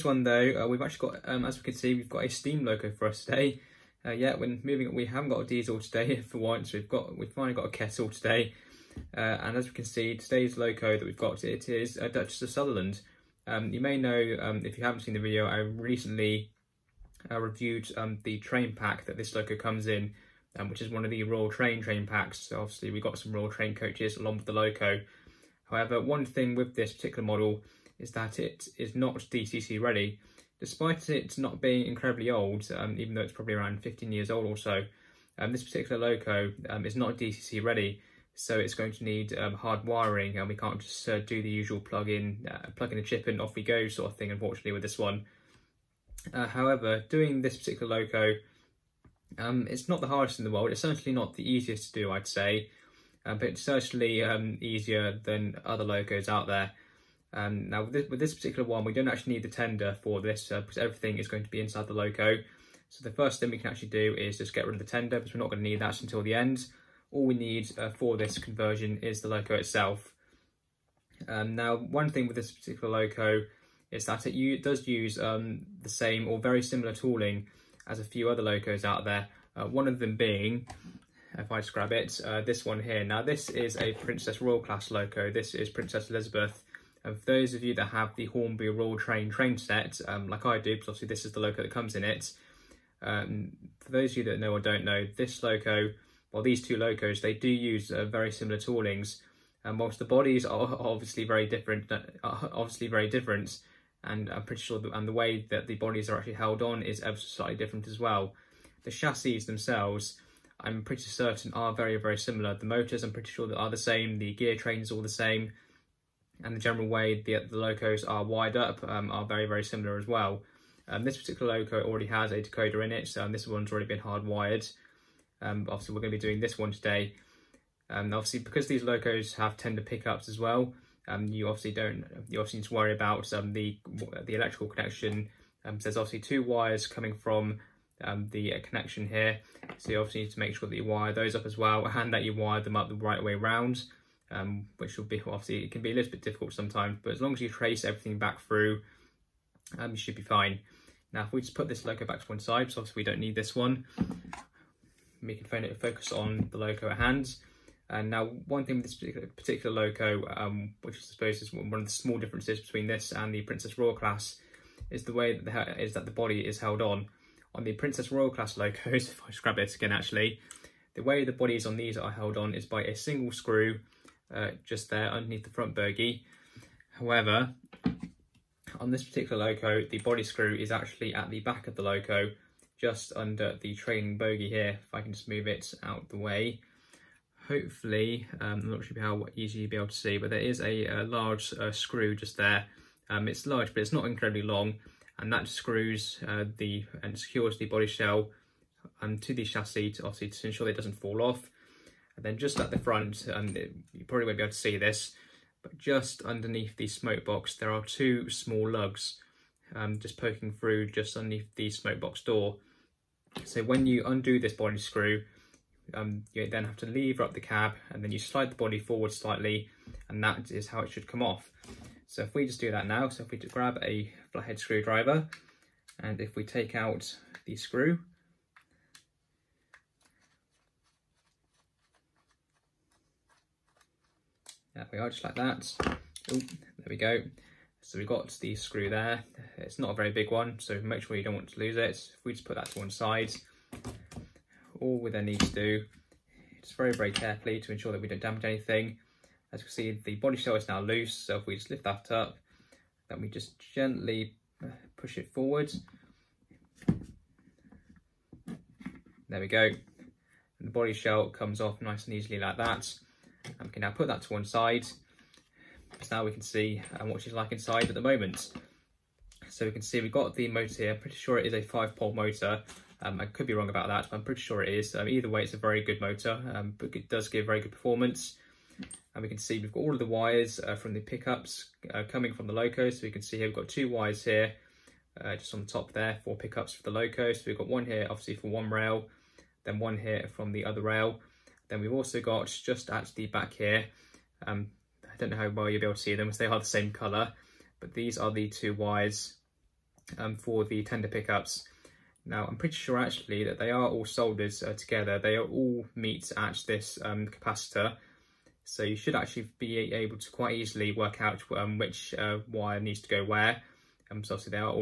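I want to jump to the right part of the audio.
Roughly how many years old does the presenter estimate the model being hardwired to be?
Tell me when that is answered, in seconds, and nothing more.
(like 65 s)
33 s.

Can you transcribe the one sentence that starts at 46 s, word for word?
Uh, however, doing this particular Loco um, it's not the hardest in the world.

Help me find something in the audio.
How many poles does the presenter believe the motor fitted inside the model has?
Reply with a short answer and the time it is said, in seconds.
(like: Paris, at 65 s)
five pole motor, at 271 s.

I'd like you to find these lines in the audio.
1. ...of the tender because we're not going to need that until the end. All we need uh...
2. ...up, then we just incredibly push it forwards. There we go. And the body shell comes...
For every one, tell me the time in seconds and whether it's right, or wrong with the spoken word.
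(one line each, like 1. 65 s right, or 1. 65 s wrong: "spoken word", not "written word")
1. 64 s right
2. 252 s wrong: "gently", not "incredibly".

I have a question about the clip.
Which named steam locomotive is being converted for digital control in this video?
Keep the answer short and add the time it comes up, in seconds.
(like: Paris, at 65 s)
Duchess of Sutherland, at 11 s.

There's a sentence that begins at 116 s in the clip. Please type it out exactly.
And the general way the, the locos are wired up um, are very, very similar as well.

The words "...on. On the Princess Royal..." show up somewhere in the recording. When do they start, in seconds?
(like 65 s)
166 s.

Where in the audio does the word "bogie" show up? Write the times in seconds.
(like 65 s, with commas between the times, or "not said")
175 s, 184 s.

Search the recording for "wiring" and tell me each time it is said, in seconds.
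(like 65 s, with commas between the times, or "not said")
39 s.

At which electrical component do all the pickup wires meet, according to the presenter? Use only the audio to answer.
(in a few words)
capacitor.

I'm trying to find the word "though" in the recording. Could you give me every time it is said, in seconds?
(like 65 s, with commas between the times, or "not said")
0 s, 33 s.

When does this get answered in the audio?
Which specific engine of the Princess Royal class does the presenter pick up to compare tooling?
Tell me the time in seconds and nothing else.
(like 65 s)
85 s.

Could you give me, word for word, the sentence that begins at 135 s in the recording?
Um, so there's obviously two wires coming from um, the uh, connection here.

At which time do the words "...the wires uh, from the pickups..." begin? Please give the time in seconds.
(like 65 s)
279 s.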